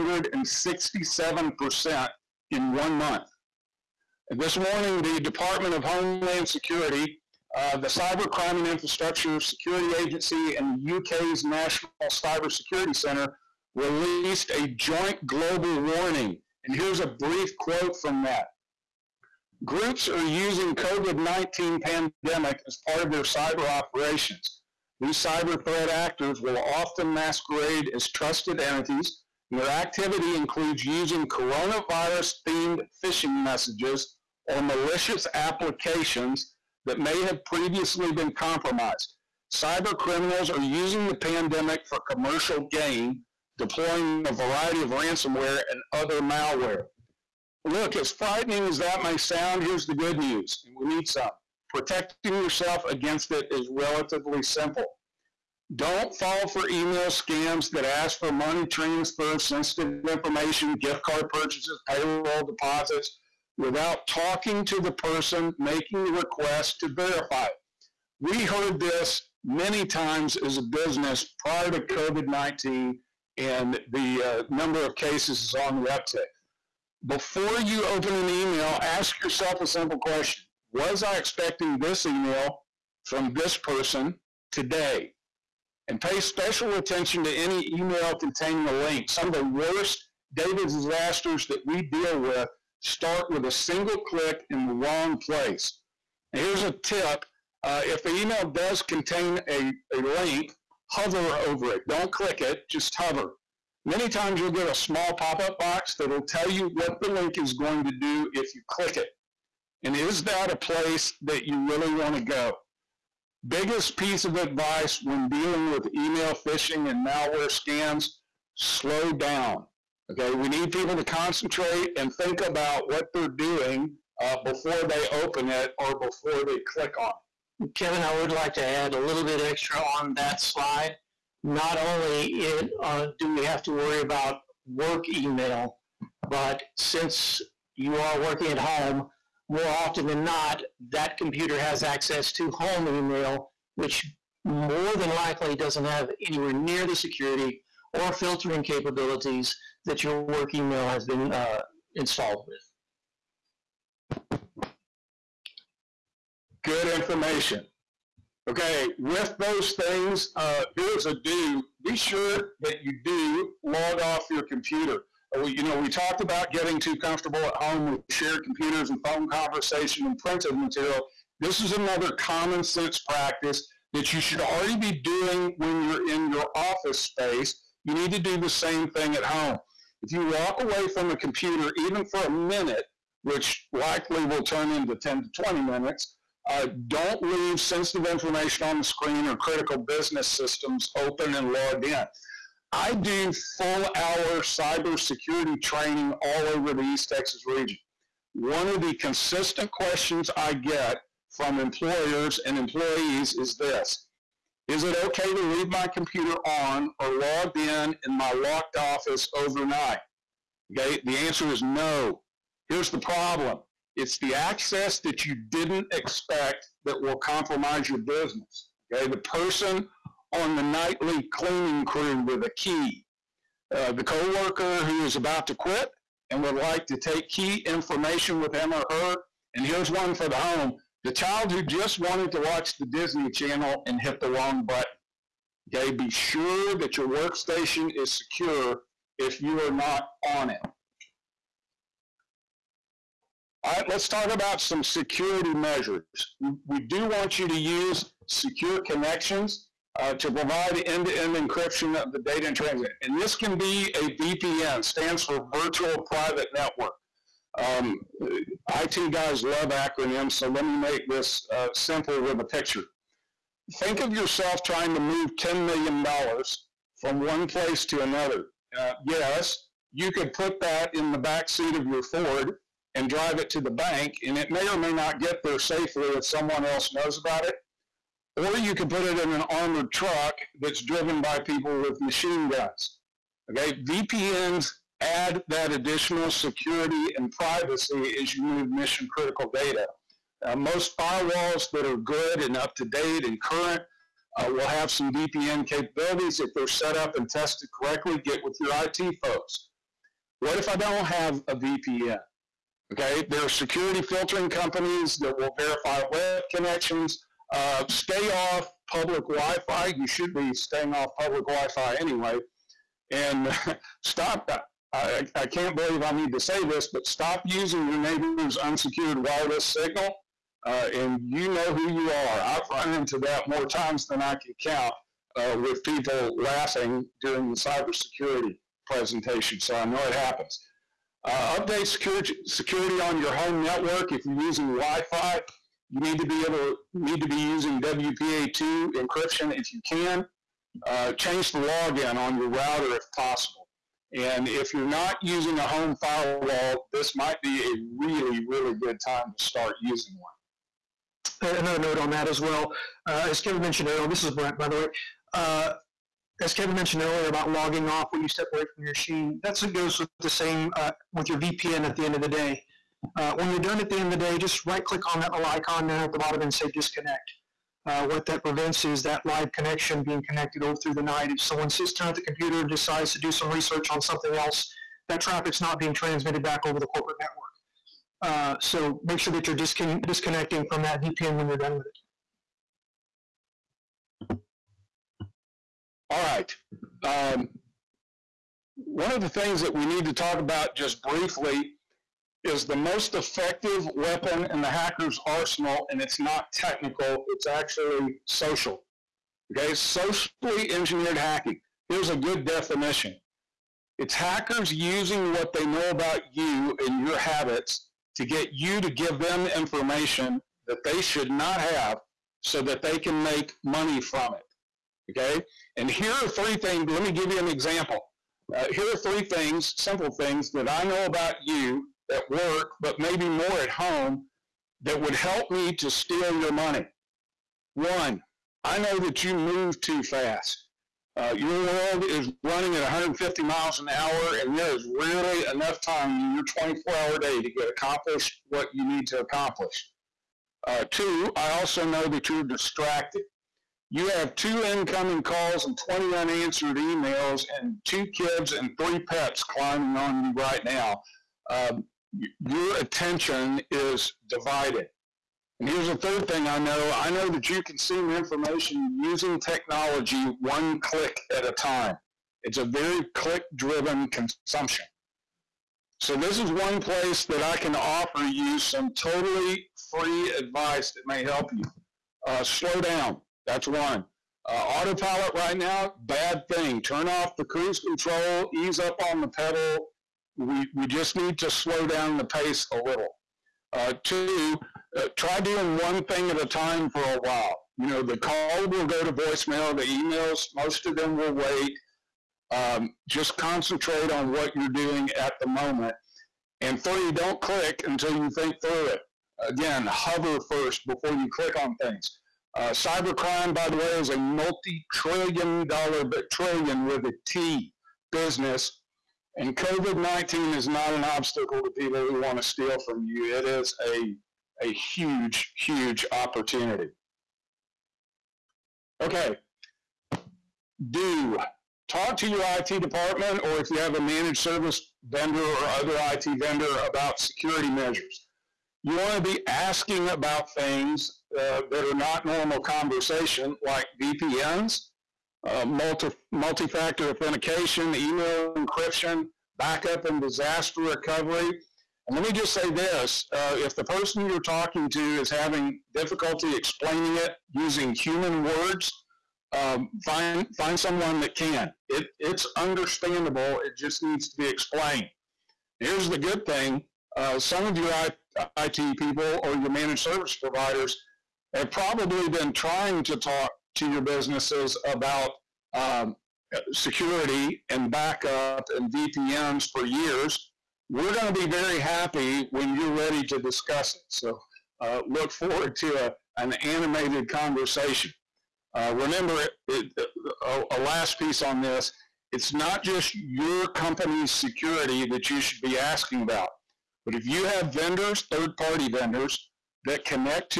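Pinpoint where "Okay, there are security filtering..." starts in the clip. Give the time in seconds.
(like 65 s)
302 s.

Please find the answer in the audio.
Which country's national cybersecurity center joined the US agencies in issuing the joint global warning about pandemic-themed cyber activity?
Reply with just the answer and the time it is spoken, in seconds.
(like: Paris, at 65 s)
UK, at 10 s.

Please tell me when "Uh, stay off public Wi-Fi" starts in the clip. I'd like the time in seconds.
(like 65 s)
307 s.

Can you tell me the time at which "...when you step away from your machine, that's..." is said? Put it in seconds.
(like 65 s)
358 s.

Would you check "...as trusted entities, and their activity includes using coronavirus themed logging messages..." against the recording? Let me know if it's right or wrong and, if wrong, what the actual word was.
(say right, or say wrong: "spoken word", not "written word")
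wrong: "phishing", not "logging".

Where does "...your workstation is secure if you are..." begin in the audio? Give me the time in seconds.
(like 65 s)
236 s.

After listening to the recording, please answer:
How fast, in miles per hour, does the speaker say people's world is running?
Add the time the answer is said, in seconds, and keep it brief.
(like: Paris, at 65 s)
150 miles an hour, at 432 s.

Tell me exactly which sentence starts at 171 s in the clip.
This is another common sense practice that you should already be doing when you're in your office space.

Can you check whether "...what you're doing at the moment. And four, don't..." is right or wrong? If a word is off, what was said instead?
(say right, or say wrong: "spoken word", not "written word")
wrong: "three", not "four".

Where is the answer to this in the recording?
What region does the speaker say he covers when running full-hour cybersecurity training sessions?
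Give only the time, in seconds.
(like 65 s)
196 s.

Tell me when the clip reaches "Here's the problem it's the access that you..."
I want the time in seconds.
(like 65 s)
212 s.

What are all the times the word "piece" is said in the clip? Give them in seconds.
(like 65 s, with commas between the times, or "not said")
113 s, 581 s.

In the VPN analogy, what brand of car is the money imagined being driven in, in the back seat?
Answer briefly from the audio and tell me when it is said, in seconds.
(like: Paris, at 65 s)
Ford, at 272 s.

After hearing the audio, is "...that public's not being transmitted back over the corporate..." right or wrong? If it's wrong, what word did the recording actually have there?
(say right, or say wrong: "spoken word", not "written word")
wrong: "traffic", not "public".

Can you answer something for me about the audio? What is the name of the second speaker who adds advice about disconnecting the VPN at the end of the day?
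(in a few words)
Brent.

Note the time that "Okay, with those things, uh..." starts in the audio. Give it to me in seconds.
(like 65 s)
158 s.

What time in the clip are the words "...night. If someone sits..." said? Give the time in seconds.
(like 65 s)
371 s.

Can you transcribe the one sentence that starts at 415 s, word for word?
Okay, and here are three things.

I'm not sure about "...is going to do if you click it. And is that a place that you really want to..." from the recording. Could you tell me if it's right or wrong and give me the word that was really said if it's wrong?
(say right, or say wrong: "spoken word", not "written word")
right.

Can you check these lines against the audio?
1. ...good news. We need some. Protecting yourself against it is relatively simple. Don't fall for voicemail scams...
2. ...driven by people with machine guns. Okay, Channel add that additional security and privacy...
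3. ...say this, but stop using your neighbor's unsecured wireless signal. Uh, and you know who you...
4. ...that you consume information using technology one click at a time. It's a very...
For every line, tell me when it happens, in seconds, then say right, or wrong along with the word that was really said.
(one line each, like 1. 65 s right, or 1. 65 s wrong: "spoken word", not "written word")
1. 49 s wrong: "email", not "voicemail"
2. 280 s wrong: "VPNs", not "Channel"
3. 316 s right
4. 457 s right.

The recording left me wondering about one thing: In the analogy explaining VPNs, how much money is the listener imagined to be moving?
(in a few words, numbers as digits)
$10 million.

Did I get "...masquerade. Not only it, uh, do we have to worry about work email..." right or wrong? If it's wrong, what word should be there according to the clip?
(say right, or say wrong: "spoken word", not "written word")
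wrong: "slide", not "masquerade".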